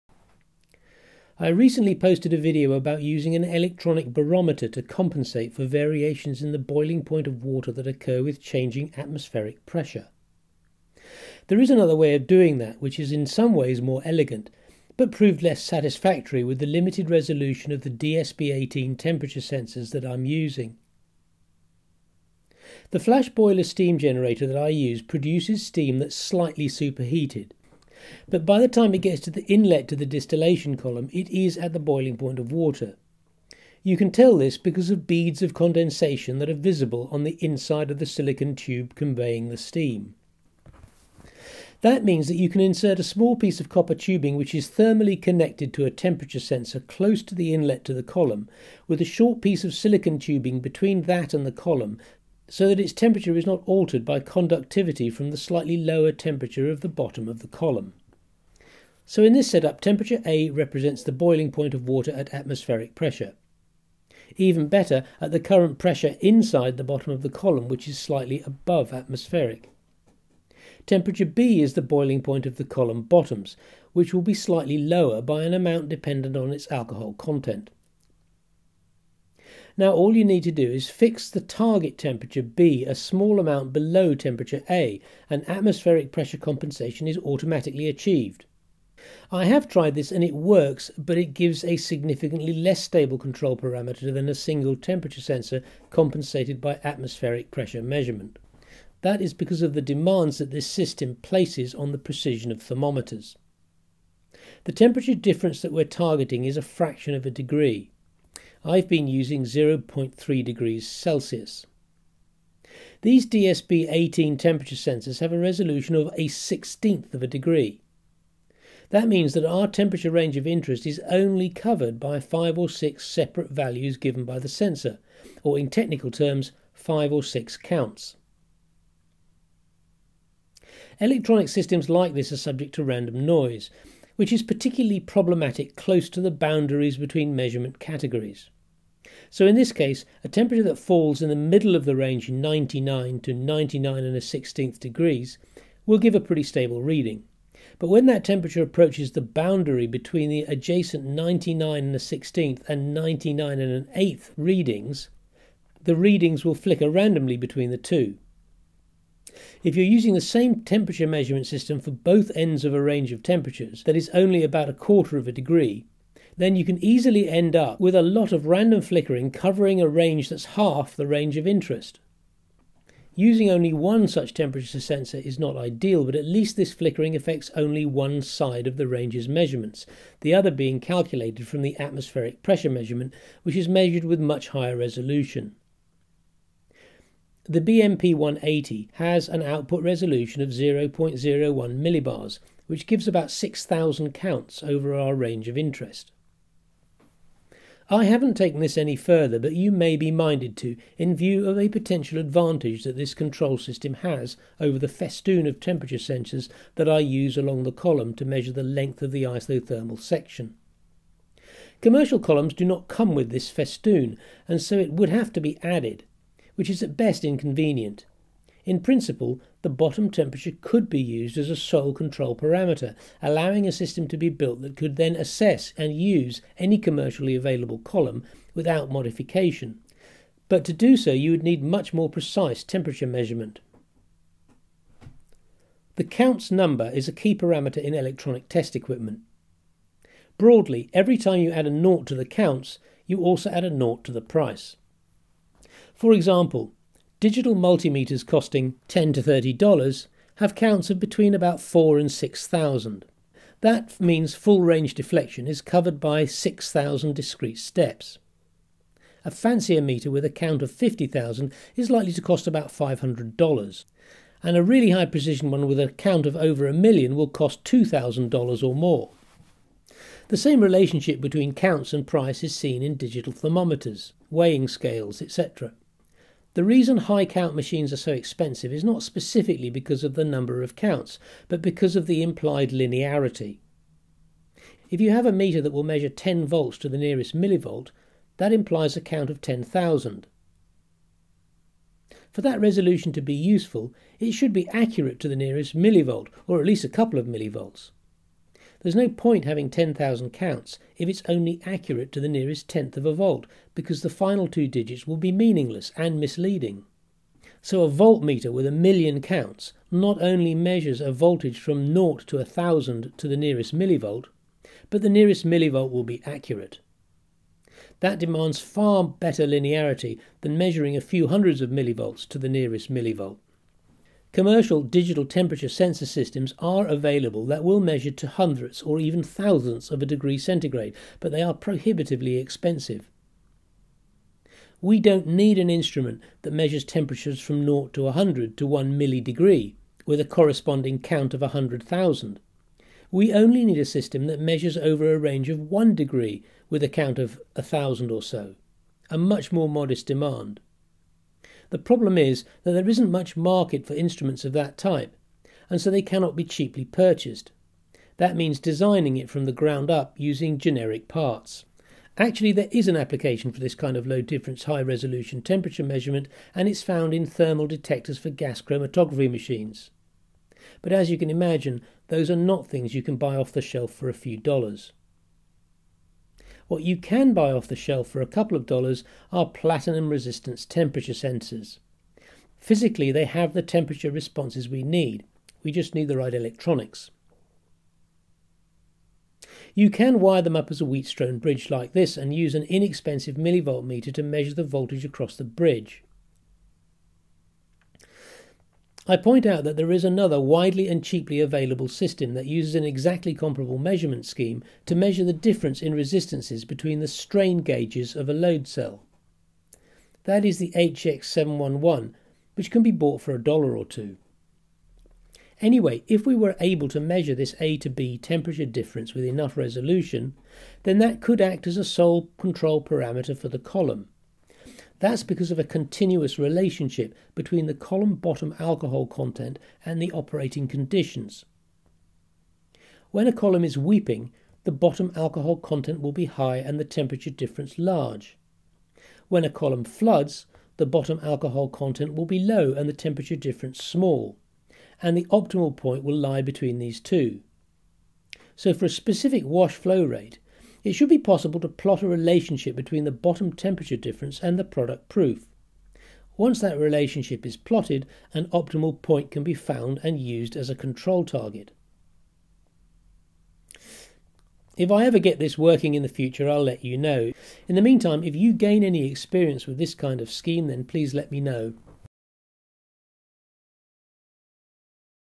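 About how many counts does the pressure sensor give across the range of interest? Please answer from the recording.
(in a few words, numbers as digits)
6,000.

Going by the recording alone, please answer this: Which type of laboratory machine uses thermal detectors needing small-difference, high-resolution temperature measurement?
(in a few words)
Gas chromatography machines.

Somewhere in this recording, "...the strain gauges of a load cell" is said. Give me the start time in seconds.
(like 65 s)
406 s.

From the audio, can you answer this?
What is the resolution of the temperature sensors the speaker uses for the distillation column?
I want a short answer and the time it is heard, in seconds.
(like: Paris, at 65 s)
1/16 of a degree, at 116 s.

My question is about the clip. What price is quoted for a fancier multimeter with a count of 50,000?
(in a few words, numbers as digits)
$500.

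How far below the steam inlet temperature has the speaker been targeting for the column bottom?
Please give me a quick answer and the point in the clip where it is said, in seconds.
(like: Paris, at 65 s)
0.3 degrees Celsius, at 109 s.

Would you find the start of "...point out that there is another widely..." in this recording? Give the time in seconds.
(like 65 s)
399 s.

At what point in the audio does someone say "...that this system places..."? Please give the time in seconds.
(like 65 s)
100 s.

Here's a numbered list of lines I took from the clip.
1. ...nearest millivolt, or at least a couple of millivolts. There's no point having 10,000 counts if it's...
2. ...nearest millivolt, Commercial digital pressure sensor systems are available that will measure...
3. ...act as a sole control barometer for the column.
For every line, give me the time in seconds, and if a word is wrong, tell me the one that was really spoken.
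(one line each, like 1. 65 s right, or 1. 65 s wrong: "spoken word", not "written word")
1. 295 s right
2. 322 s wrong: "temperature", not "pressure"
3. 421 s wrong: "parameter", not "barometer".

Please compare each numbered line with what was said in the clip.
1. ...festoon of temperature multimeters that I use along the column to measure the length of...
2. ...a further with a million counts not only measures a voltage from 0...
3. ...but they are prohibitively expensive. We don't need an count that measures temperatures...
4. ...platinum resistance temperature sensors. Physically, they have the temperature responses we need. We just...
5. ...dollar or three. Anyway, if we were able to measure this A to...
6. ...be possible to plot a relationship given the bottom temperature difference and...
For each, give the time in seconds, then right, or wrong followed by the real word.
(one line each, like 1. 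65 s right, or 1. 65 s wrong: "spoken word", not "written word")
1. 204 s wrong: "sensors", not "multimeters"
2. 307 s wrong: "voltmeter", not "further"
3. 331 s wrong: "instrument", not "count"
4. 379 s right
5. 413 s wrong: "two", not "three"
6. 451 s wrong: "between", not "given".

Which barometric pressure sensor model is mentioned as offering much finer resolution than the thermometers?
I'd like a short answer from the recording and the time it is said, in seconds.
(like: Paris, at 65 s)
BMP 180, at 187 s.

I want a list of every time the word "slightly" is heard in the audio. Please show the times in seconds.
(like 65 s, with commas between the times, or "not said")
26 s, 55 s, 67 s, 74 s.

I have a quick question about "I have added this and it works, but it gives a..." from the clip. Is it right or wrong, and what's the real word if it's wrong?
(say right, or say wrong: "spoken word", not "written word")
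wrong: "tried", not "added".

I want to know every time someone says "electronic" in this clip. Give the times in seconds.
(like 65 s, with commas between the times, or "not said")
3 s, 130 s, 237 s, 386 s.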